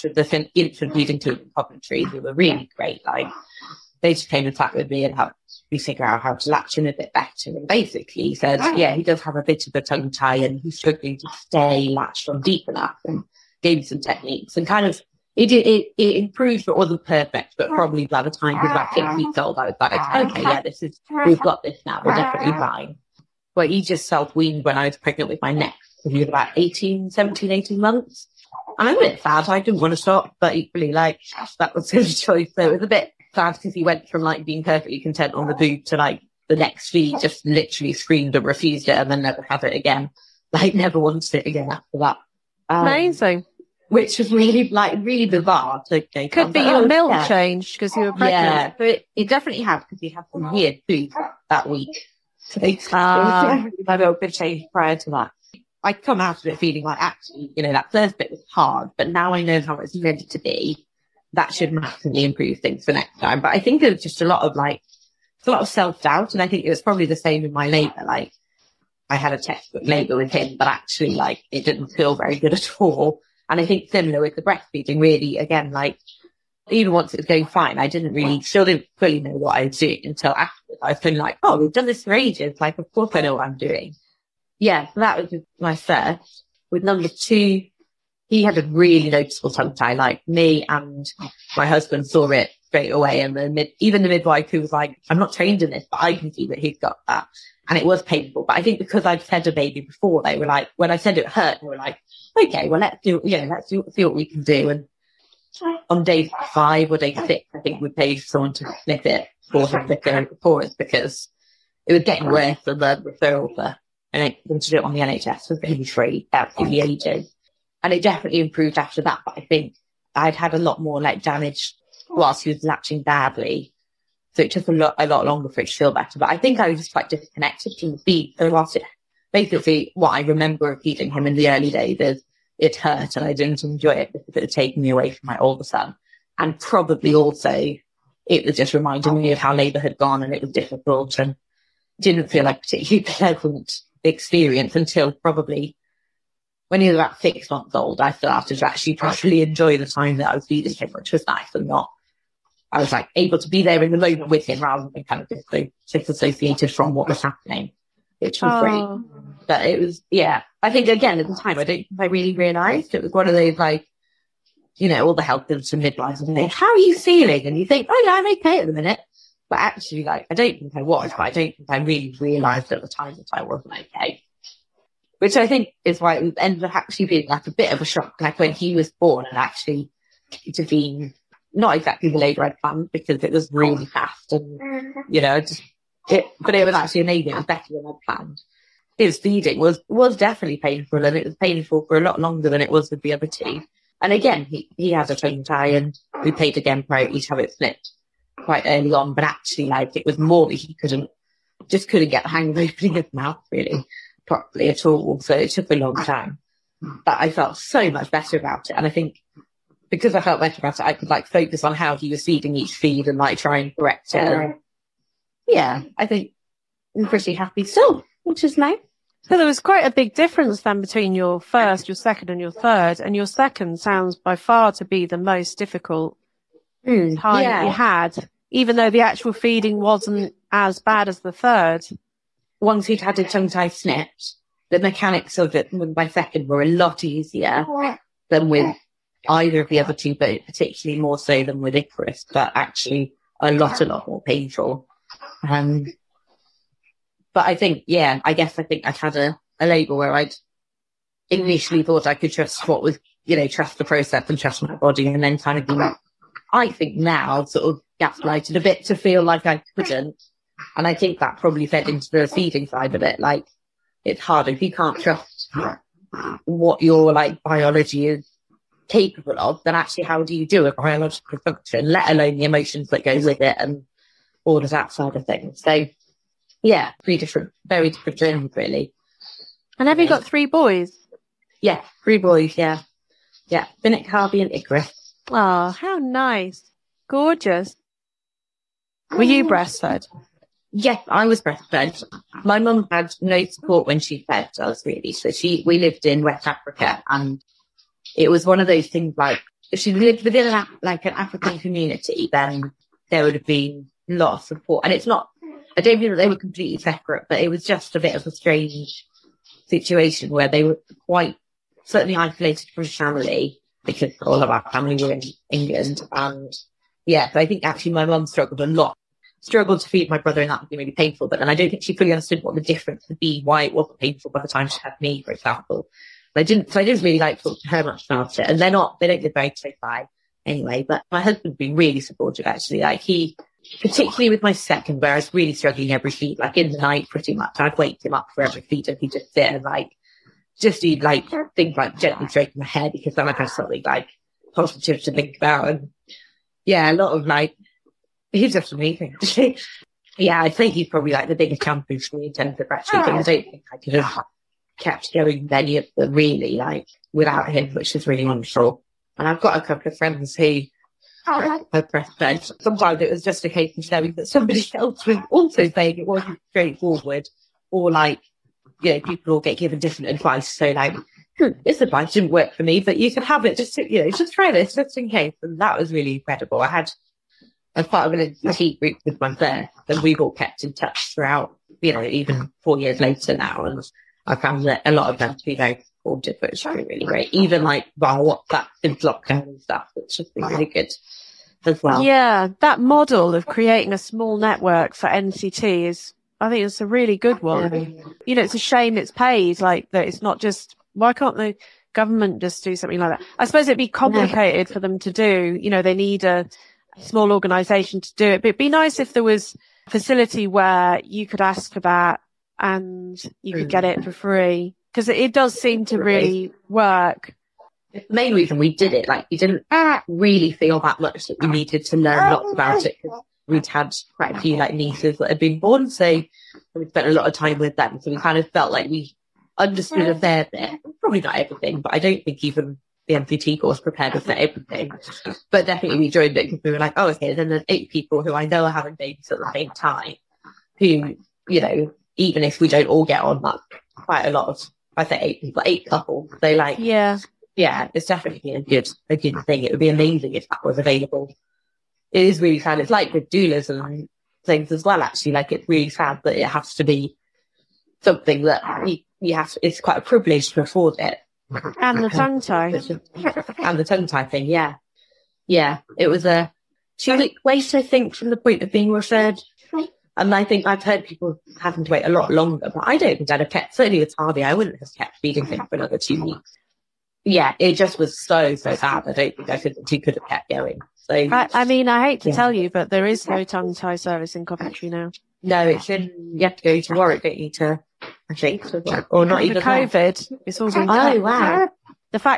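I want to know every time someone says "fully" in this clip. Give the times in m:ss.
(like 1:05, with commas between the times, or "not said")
1:18, 5:21.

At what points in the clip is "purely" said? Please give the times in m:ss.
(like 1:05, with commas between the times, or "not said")
not said.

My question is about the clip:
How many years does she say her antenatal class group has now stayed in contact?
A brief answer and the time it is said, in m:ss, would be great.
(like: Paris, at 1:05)
4, at 6:22.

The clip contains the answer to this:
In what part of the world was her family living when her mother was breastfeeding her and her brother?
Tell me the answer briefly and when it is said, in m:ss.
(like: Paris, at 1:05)
West Africa, at 4:56.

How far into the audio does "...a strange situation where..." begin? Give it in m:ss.
5:08.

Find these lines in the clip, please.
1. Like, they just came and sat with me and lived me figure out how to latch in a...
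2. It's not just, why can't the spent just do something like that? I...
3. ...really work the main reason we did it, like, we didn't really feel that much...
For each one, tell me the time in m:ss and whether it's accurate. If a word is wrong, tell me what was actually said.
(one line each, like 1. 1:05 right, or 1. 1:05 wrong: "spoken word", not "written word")
1. 0:03 wrong: "helped", not "lived"
2. 6:40 wrong: "government", not "spent"
3. 6:55 right.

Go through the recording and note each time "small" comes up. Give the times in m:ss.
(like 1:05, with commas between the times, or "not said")
6:33, 6:46.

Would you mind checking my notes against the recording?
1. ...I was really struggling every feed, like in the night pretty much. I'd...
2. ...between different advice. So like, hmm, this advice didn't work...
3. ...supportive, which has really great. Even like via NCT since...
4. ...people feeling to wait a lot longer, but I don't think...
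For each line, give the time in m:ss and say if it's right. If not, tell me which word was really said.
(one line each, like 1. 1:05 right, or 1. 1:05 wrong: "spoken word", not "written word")
1. 5:35 right
2. 6:09 wrong: "given", not "between"
3. 6:25 wrong: "WhatsApp", not "NCT"
4. 7:51 wrong: "having", not "feeling".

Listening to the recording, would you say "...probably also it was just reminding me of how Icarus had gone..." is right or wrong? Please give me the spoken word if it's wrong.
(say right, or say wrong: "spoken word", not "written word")
wrong: "Labour", not "Icarus".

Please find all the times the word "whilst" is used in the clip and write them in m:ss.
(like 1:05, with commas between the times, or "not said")
2:02, 2:08.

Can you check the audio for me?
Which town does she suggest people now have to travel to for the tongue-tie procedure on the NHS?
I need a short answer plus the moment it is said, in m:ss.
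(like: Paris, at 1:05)
Warwick, at 8:06.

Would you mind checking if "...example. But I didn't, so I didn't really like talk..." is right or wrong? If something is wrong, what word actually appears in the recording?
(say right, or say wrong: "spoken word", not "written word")
right.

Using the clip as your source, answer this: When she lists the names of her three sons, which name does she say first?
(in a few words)
Finnick.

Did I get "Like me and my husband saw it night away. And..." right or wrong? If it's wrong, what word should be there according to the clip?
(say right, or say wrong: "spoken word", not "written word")
wrong: "straight", not "night".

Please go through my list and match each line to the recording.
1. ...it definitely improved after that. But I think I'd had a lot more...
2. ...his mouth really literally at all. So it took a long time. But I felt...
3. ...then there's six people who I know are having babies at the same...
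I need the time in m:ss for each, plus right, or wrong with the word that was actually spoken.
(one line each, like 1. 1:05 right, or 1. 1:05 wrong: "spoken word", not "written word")
1. 1:57 right
2. 3:22 wrong: "properly", not "literally"
3. 7:17 wrong: "eight", not "six".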